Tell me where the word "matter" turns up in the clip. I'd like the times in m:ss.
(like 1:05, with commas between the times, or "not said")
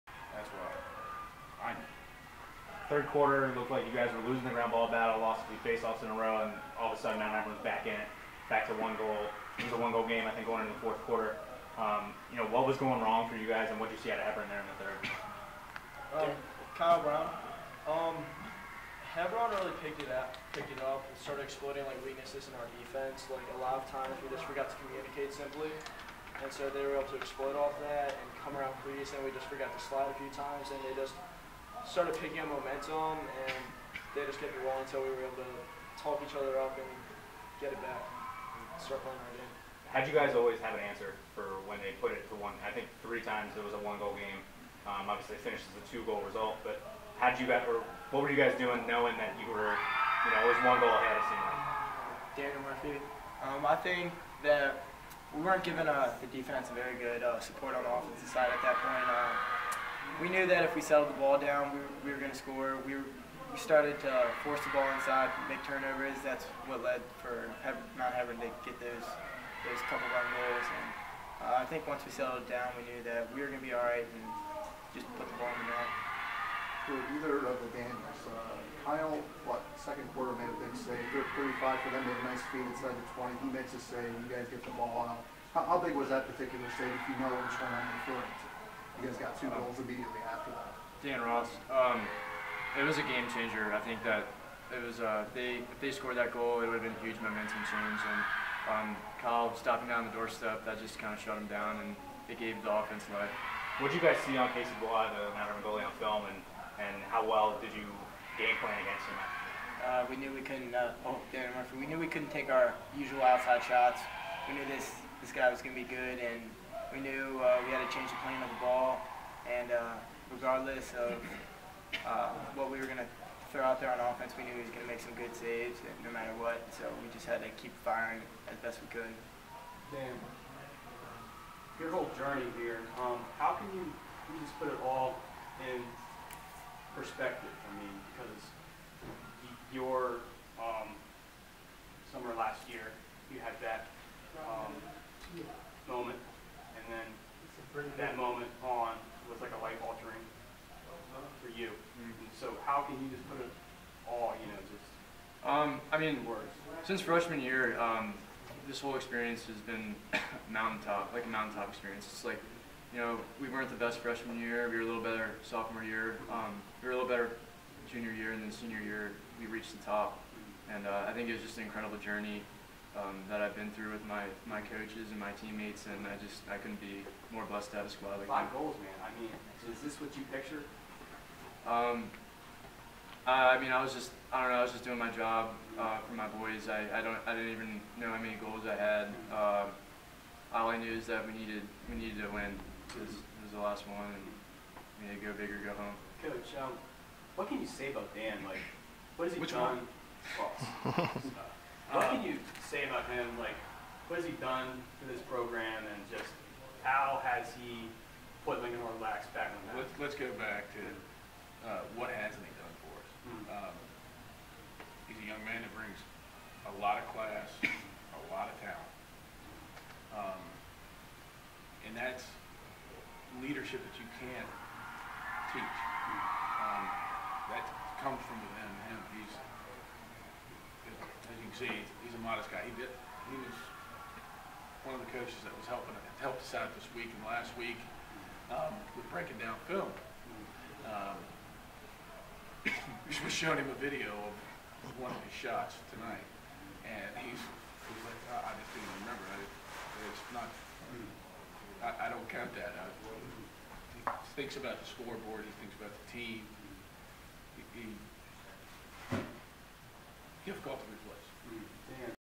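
2:06.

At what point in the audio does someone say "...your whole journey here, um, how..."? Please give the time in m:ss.
2:11.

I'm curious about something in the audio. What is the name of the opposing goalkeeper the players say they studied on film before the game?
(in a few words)
Casey Blois.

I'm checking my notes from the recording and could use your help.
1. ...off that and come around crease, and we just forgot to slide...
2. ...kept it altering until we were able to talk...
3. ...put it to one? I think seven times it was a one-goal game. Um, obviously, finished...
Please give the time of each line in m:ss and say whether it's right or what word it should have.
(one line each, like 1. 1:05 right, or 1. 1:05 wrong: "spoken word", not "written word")
1. 0:27 right
2. 0:34 wrong: "rolling", not "altering"
3. 0:41 wrong: "three", not "seven".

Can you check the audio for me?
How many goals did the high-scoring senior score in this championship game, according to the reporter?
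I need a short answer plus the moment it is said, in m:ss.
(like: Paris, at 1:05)
5, at 2:58.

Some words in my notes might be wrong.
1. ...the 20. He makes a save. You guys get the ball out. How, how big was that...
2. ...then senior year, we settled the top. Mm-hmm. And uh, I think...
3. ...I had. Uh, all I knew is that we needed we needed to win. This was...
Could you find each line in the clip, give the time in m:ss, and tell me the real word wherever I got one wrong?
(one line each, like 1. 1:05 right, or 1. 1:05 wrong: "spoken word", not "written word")
1. 1:22 right
2. 2:48 wrong: "reached", not "settled"
3. 3:08 right.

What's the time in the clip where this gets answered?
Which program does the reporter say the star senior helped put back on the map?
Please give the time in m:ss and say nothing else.
3:28.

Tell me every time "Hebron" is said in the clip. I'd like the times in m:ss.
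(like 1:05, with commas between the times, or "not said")
0:07, 0:14, 0:19, 1:08.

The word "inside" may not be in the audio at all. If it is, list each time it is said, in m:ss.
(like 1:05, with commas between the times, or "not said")
1:04, 1:22.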